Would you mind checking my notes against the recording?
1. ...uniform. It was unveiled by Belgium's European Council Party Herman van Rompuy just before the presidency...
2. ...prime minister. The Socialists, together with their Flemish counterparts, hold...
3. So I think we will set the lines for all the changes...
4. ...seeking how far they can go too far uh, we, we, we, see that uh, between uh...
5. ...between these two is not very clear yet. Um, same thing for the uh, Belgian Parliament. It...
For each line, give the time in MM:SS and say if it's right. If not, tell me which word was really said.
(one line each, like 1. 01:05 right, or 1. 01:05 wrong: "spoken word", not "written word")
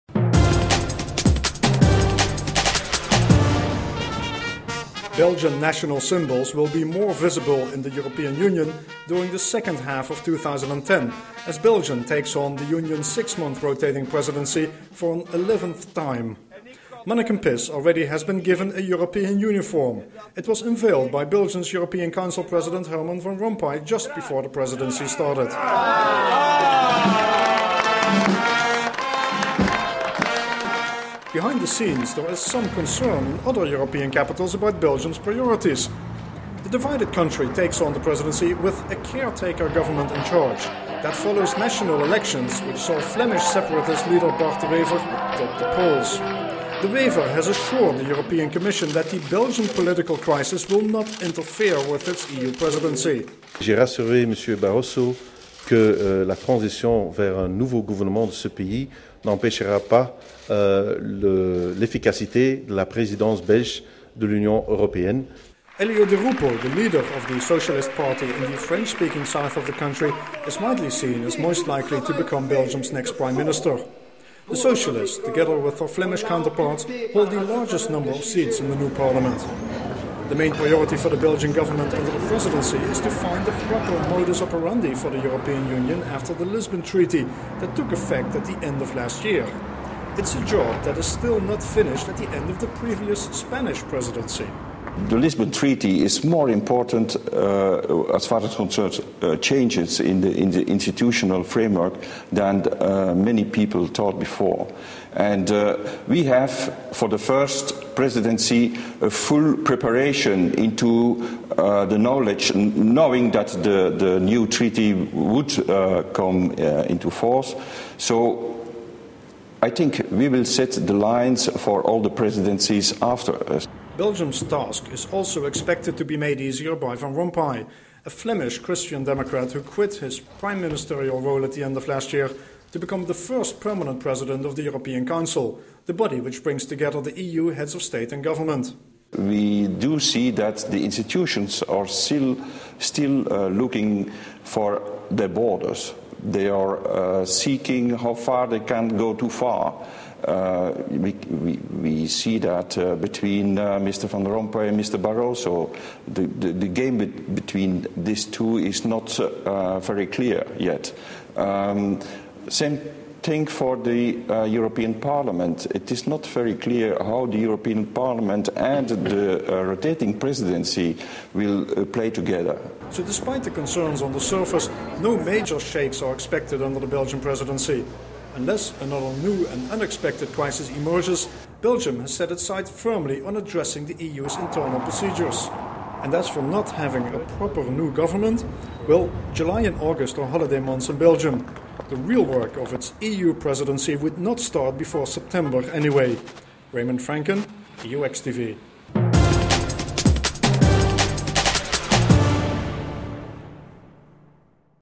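1. 00:19 wrong: "President", not "Party"
2. 01:13 right
3. 01:57 wrong: "presidencies", not "changes"
4. 02:27 right
5. 02:37 wrong: "European", not "Belgian".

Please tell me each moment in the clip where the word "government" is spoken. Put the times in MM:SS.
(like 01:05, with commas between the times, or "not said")
00:39, 01:21, 02:18, 03:07.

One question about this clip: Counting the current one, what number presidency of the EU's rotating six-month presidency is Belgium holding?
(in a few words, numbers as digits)
11th.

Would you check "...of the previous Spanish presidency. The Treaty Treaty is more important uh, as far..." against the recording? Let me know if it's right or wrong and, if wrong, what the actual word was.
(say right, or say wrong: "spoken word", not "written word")
wrong: "Lisbon", not "Treaty".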